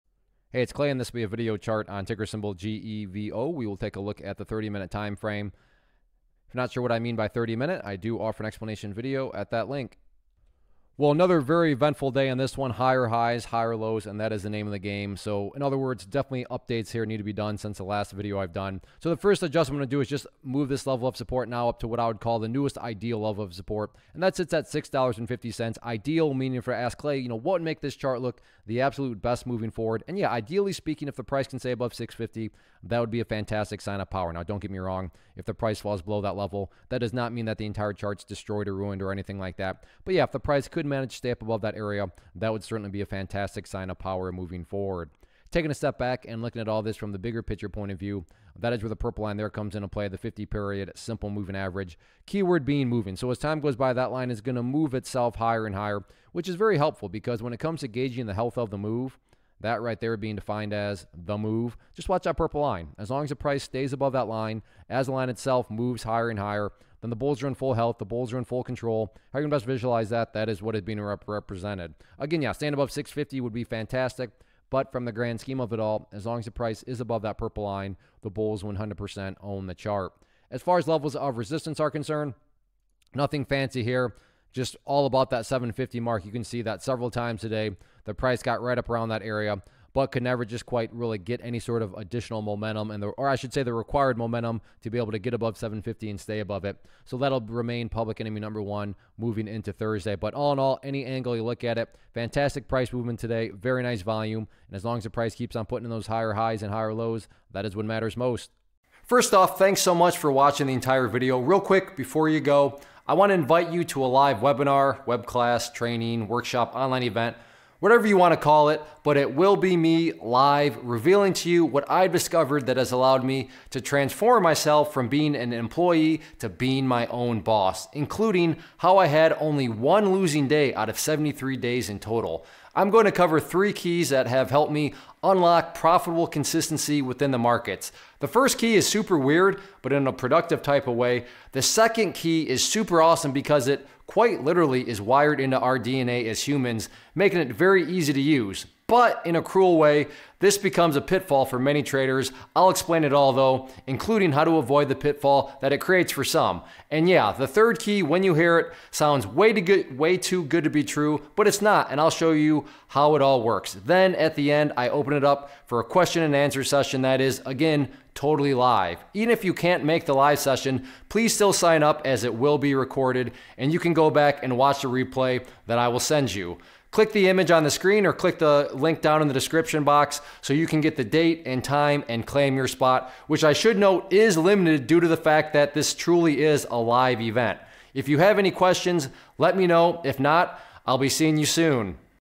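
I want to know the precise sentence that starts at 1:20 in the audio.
As far as levels of resistance are concerned, nothing fancy here.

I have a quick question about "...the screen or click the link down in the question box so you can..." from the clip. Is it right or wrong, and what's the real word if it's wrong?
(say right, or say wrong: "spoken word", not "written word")
wrong: "description", not "question".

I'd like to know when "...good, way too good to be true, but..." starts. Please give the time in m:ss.
2:39.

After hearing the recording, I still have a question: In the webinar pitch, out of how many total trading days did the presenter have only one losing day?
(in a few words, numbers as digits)
73.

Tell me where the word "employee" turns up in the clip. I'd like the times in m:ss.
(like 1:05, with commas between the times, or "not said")
2:05.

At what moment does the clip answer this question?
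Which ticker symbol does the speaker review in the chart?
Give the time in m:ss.
0:02.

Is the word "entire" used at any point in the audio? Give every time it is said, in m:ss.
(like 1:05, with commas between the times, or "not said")
0:37, 1:50.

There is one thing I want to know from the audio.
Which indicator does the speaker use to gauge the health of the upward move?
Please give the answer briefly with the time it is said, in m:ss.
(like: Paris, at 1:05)
50 period simple moving average, at 0:50.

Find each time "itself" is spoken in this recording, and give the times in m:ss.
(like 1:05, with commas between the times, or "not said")
0:54, 1:05.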